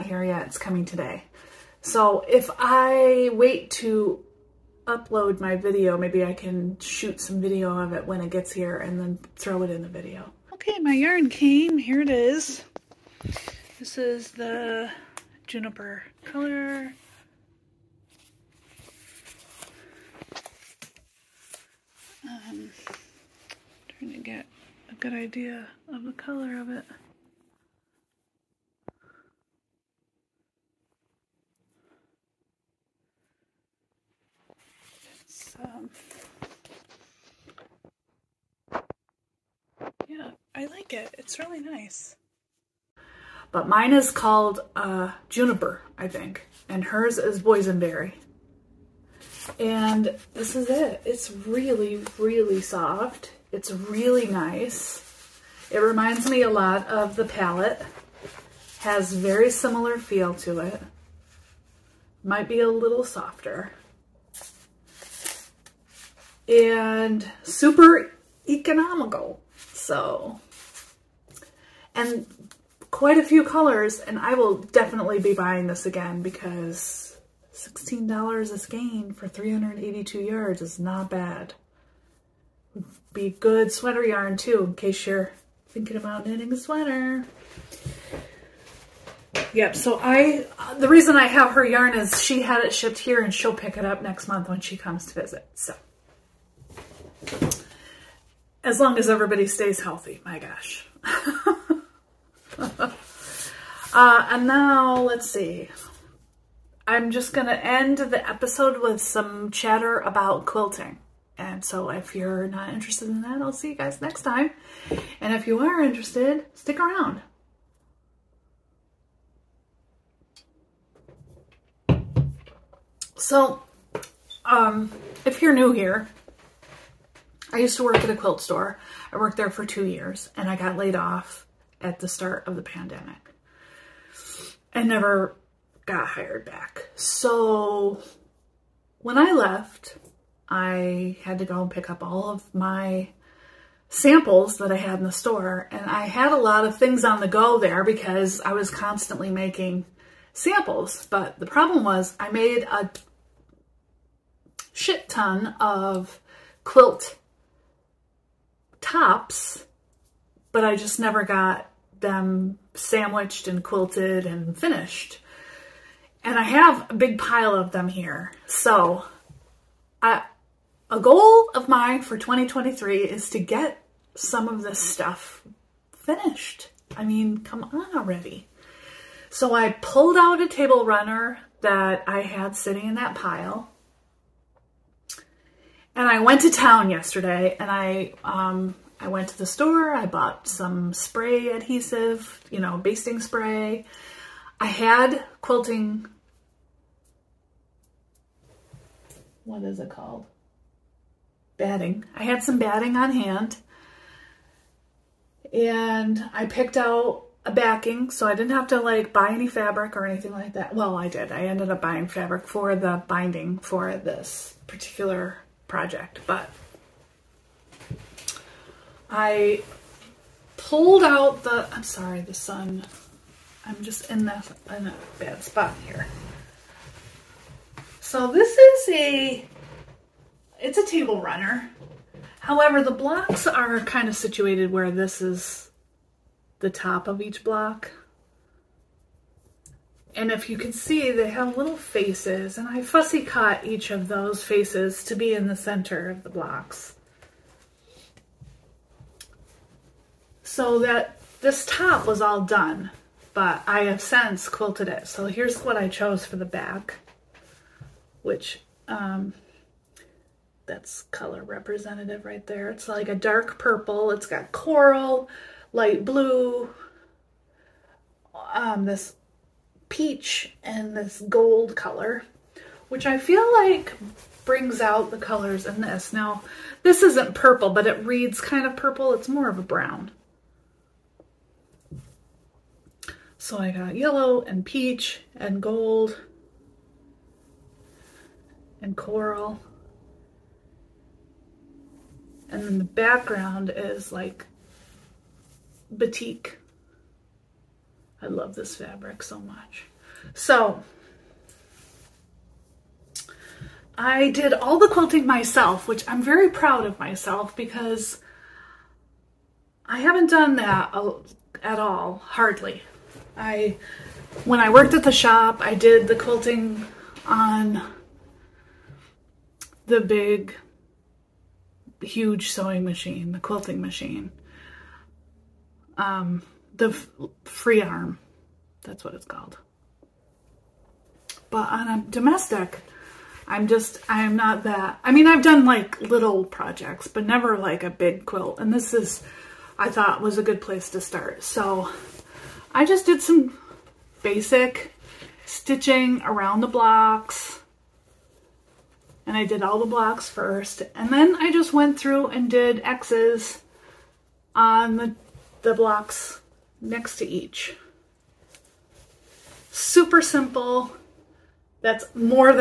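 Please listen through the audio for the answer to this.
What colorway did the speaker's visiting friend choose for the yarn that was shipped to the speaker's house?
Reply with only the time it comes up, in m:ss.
0:47.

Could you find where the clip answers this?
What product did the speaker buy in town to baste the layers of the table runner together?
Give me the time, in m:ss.
3:10.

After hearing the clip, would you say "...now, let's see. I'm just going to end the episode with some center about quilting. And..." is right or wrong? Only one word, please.
wrong.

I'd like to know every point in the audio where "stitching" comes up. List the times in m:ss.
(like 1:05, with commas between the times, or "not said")
5:45.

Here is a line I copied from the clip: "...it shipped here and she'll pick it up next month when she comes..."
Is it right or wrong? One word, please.
right.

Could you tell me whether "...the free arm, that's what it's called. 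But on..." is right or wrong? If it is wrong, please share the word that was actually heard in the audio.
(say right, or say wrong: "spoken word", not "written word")
right.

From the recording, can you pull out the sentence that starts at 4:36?
Now, this isn't purple, but it reads kind of purple.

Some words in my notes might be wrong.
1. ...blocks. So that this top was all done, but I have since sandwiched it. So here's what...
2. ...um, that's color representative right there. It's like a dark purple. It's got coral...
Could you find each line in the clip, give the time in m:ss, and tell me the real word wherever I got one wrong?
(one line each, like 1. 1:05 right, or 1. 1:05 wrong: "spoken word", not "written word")
1. 4:06 wrong: "quilted", not "sandwiched"
2. 4:18 right.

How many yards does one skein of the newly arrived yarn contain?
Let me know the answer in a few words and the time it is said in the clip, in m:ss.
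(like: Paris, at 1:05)
382, at 1:19.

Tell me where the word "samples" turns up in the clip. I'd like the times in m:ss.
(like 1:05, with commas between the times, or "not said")
2:23, 2:30.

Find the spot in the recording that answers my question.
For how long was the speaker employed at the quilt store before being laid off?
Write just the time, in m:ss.
2:09.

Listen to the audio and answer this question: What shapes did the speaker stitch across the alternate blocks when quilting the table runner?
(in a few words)
X's.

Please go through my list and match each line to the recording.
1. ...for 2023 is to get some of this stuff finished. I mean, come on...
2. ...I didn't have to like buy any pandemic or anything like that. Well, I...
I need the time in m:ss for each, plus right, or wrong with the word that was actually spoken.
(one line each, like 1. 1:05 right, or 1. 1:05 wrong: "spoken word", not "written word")
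1. 2:52 right
2. 3:28 wrong: "fabric", not "pandemic".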